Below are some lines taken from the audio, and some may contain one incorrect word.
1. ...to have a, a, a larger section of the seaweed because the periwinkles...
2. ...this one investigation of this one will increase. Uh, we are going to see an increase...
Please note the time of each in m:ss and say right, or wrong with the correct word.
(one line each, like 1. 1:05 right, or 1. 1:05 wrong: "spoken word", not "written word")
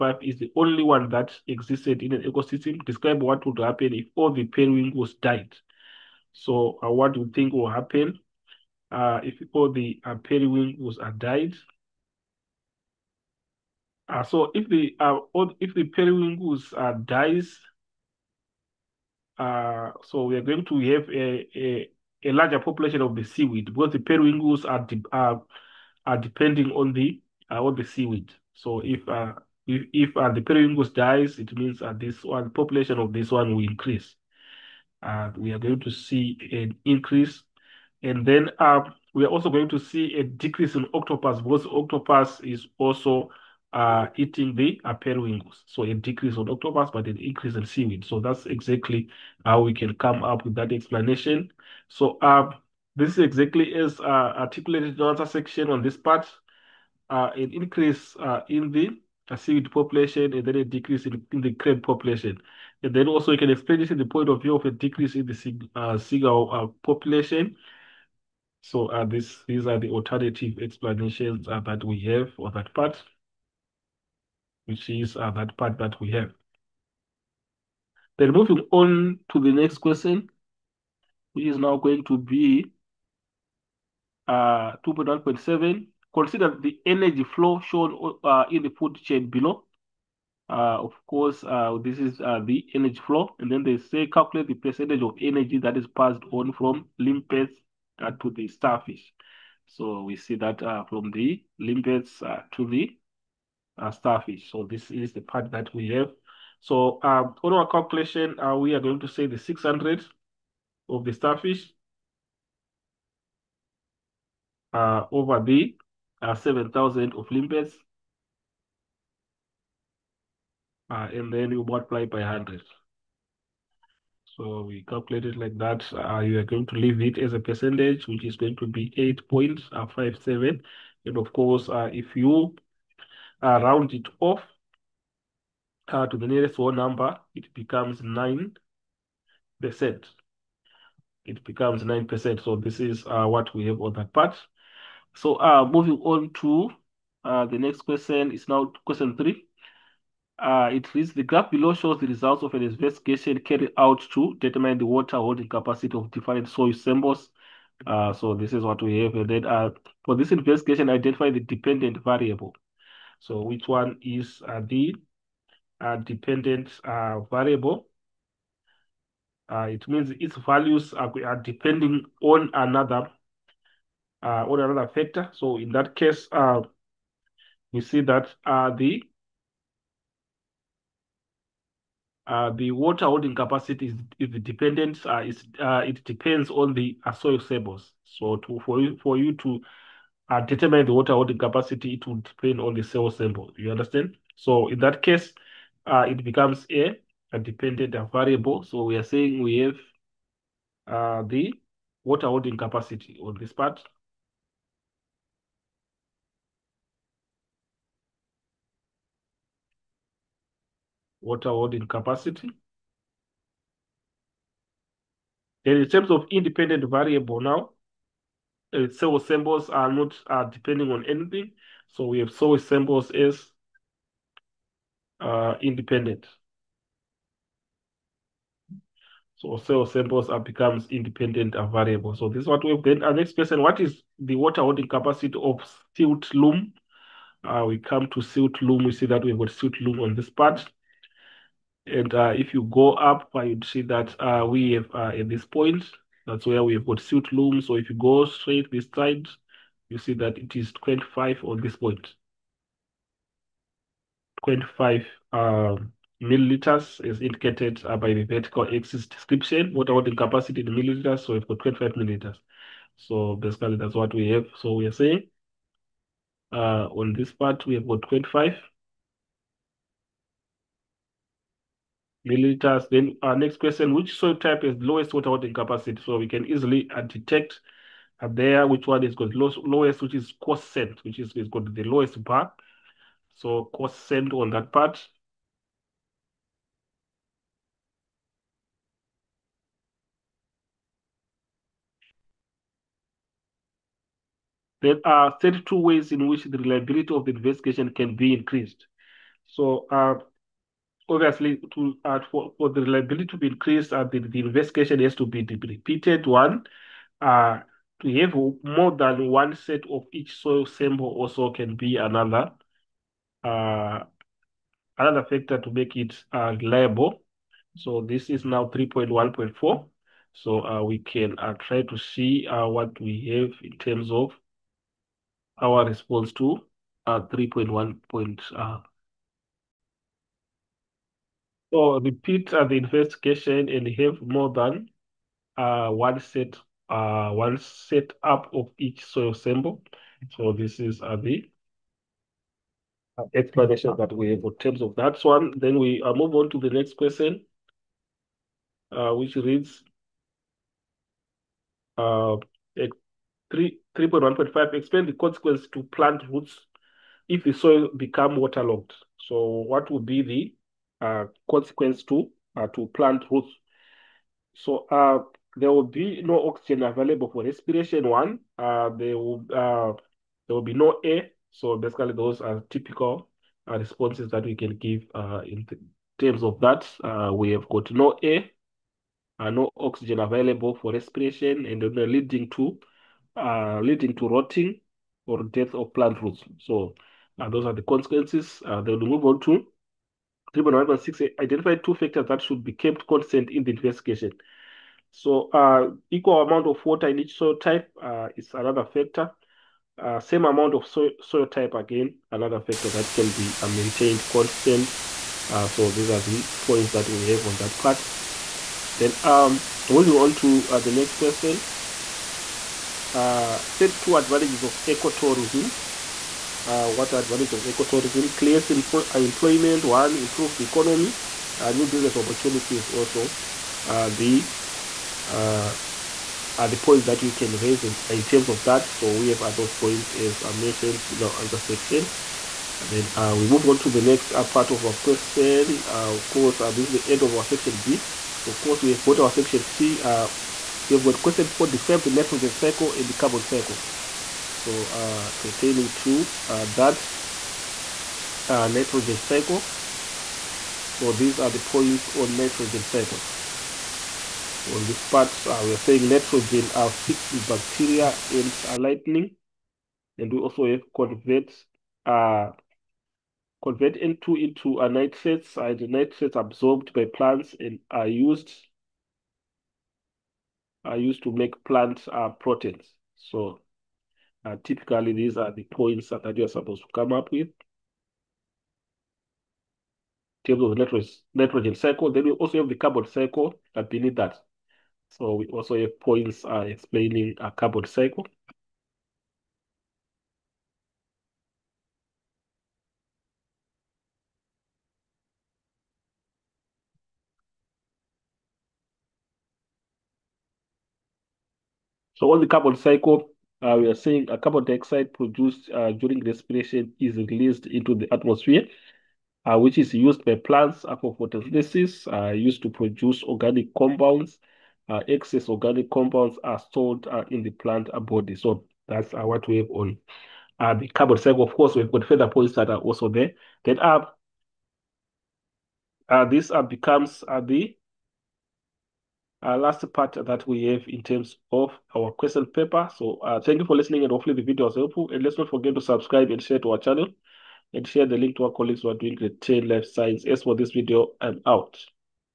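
1. 0:20 wrong: "population", not "section"
2. 0:31 wrong: "population", not "investigation".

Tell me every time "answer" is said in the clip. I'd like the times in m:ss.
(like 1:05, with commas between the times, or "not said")
7:11.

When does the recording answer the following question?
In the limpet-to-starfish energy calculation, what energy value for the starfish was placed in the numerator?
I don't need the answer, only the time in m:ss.
1:49.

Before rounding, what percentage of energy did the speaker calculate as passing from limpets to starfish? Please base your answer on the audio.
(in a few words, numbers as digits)
8.57.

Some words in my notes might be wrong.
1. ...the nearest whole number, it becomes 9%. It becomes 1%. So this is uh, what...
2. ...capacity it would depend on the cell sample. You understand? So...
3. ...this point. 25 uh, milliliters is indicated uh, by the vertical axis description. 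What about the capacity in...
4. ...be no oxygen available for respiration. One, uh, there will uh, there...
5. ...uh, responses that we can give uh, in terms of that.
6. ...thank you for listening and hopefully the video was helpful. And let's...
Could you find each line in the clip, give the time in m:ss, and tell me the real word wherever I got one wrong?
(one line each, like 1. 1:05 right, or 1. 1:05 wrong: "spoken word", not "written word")
1. 2:16 wrong: "9", not "1"
2. 3:11 right
3. 4:11 right
4. 6:05 right
5. 6:13 right
6. 8:53 right.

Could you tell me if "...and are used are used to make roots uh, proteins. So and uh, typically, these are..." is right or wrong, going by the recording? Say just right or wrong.
wrong.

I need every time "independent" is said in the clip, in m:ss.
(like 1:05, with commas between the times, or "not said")
3:36, 3:45, 3:50.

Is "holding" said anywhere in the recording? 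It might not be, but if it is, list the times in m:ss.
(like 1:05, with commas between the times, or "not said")
2:35, 3:03, 3:11, 3:22, 3:31, 3:54, 4:35.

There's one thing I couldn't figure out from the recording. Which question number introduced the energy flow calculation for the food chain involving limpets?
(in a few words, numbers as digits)
2.1.7.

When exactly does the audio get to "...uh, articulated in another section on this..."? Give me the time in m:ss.
0:53.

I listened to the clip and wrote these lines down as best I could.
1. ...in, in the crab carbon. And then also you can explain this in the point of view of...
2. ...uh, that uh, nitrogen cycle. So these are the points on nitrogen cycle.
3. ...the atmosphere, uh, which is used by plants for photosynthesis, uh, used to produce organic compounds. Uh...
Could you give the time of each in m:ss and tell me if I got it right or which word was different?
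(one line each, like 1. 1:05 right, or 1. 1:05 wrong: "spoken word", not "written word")
1. 1:01 wrong: "population", not "carbon"
2. 7:26 right
3. 8:27 right.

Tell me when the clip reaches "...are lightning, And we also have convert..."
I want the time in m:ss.
7:38.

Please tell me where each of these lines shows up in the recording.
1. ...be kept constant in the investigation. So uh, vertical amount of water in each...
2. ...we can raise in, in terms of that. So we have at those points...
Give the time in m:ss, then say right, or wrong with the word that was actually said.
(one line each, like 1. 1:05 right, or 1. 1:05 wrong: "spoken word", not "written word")
1. 6:32 wrong: "equal", not "vertical"
2. 7:07 right.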